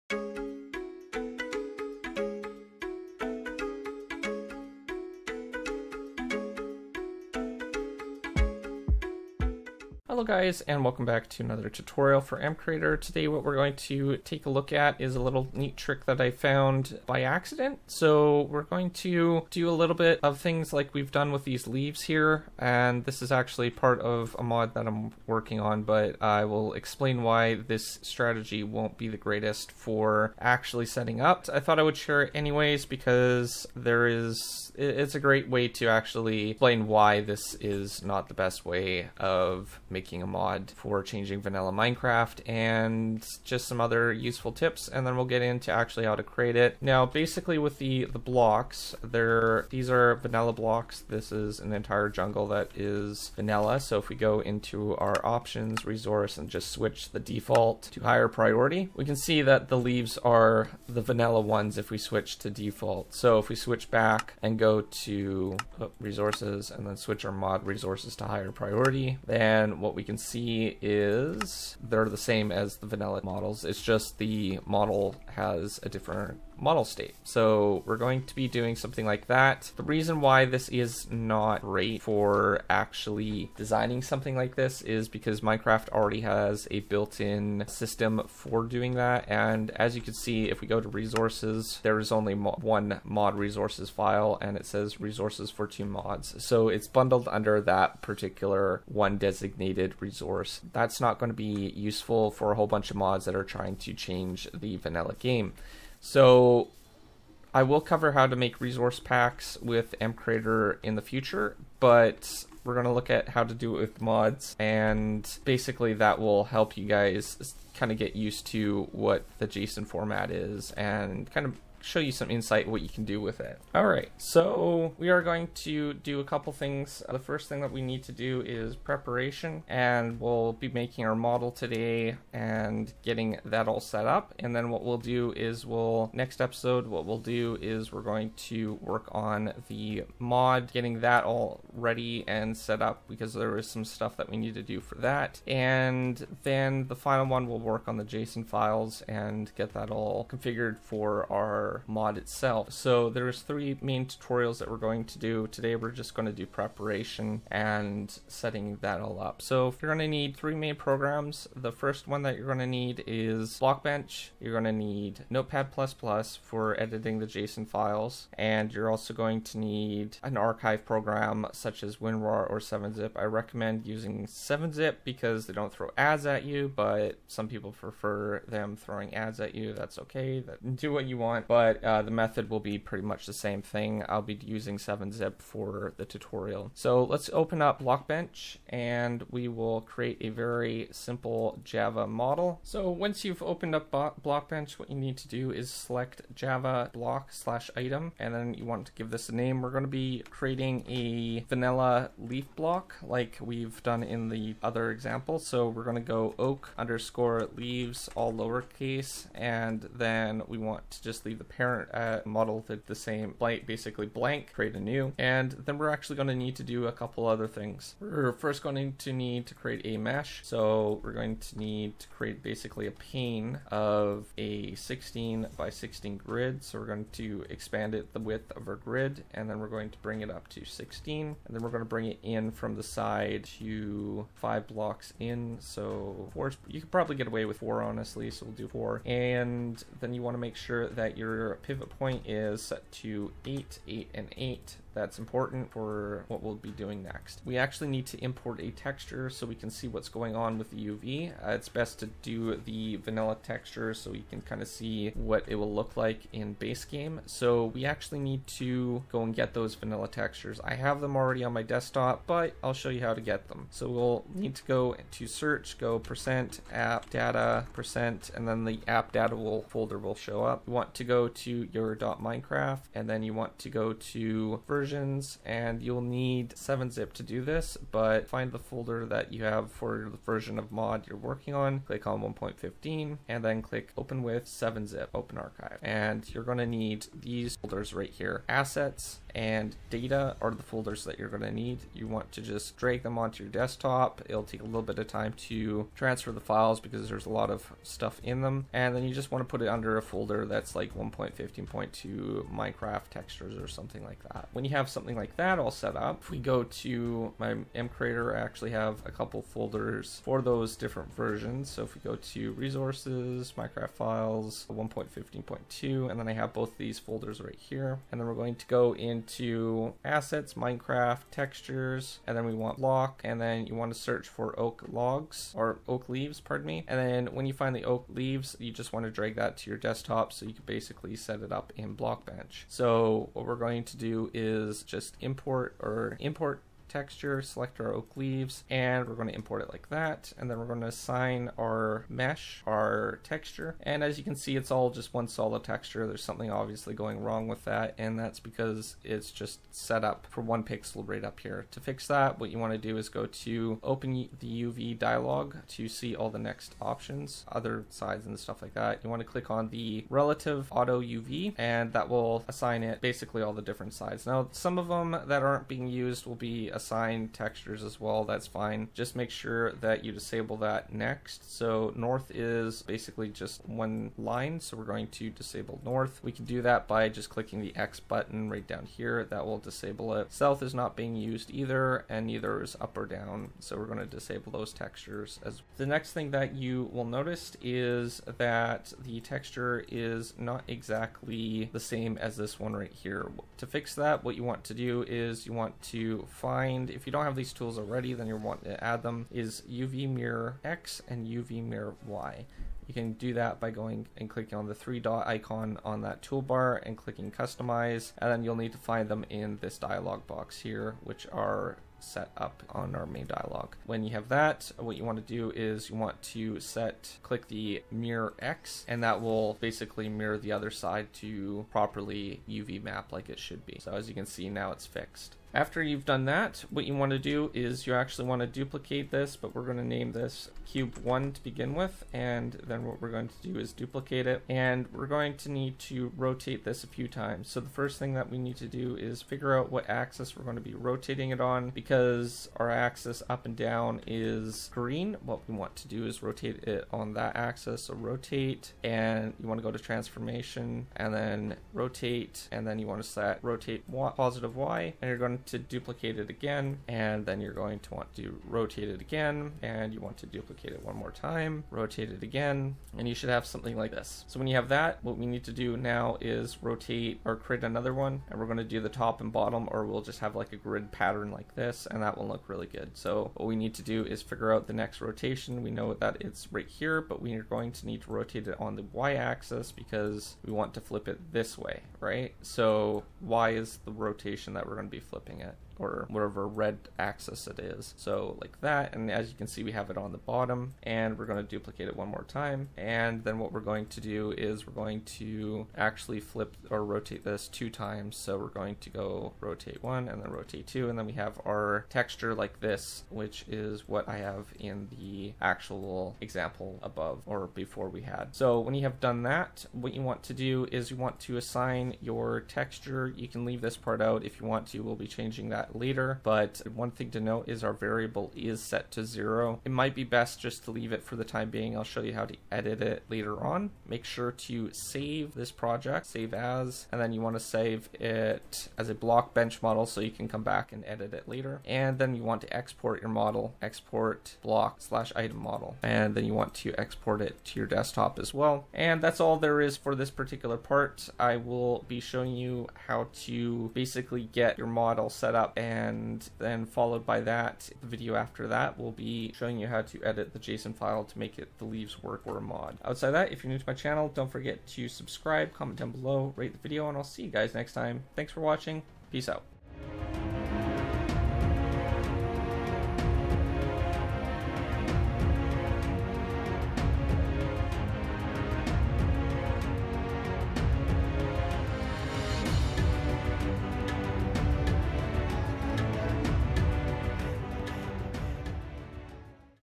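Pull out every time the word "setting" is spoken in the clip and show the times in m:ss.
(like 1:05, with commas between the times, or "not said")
0:30, 2:38.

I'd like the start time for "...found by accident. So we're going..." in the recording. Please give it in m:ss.
0:16.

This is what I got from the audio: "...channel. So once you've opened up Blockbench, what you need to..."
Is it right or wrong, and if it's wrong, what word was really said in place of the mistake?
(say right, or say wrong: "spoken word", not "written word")
wrong: "model", not "channel".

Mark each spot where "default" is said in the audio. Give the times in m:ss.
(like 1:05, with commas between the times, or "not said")
0:57, 1:02.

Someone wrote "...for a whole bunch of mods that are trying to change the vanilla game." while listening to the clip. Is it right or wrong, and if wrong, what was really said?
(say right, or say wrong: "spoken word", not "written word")
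right.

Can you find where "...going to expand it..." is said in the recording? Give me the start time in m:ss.
3:46.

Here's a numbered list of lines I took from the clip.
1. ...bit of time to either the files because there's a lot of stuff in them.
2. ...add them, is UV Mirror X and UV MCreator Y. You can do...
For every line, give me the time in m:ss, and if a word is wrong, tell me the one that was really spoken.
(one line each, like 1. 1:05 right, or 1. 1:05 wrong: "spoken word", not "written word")
1. 4:54 wrong: "transfer", not "either"
2. 6:38 wrong: "Mirror", not "MCreator".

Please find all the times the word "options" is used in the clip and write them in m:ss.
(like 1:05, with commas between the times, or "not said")
0:55, 5:56.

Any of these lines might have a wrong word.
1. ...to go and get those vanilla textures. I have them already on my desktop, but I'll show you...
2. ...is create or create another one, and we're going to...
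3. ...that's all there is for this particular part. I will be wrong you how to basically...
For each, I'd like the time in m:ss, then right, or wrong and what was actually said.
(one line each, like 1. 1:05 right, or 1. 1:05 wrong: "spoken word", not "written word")
1. 4:18 right
2. 7:46 wrong: "rotate", not "create"
3. 8:59 wrong: "showing", not "wrong".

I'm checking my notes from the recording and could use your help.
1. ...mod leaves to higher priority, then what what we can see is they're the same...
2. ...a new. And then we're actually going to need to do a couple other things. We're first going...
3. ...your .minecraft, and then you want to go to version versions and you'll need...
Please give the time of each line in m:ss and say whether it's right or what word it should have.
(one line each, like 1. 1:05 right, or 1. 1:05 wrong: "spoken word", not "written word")
1. 1:07 wrong: "resources", not "leaves"
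2. 3:34 right
3. 4:31 right.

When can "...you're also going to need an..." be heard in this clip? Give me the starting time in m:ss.
2:48.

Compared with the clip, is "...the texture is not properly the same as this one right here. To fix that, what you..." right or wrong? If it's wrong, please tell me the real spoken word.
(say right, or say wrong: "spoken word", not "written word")
wrong: "exactly", not "properly".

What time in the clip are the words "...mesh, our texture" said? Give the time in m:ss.
5:42.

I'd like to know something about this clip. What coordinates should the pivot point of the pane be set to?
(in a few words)
8, 8, and 8.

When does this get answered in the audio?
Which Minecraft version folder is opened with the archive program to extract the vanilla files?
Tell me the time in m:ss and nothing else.
4:42.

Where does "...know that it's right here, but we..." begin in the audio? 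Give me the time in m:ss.
7:55.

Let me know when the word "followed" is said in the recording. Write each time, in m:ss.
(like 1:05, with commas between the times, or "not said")
9:06.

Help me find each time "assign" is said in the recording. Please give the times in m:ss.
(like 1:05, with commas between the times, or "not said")
5:40, 6:02, 6:06, 8:31.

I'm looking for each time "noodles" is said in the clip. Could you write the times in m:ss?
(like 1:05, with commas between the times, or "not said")
not said.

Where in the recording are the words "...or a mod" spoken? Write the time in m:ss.
9:12.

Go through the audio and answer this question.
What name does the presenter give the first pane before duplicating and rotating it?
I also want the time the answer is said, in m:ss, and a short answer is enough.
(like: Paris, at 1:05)
cube 1, at 7:10.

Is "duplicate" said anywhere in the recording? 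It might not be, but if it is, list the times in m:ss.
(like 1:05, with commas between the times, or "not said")
7:08, 7:13, 7:35, 7:40, 8:11.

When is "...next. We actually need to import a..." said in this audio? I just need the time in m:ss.
4:07.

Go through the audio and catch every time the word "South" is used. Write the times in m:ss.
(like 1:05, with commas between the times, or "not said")
6:20.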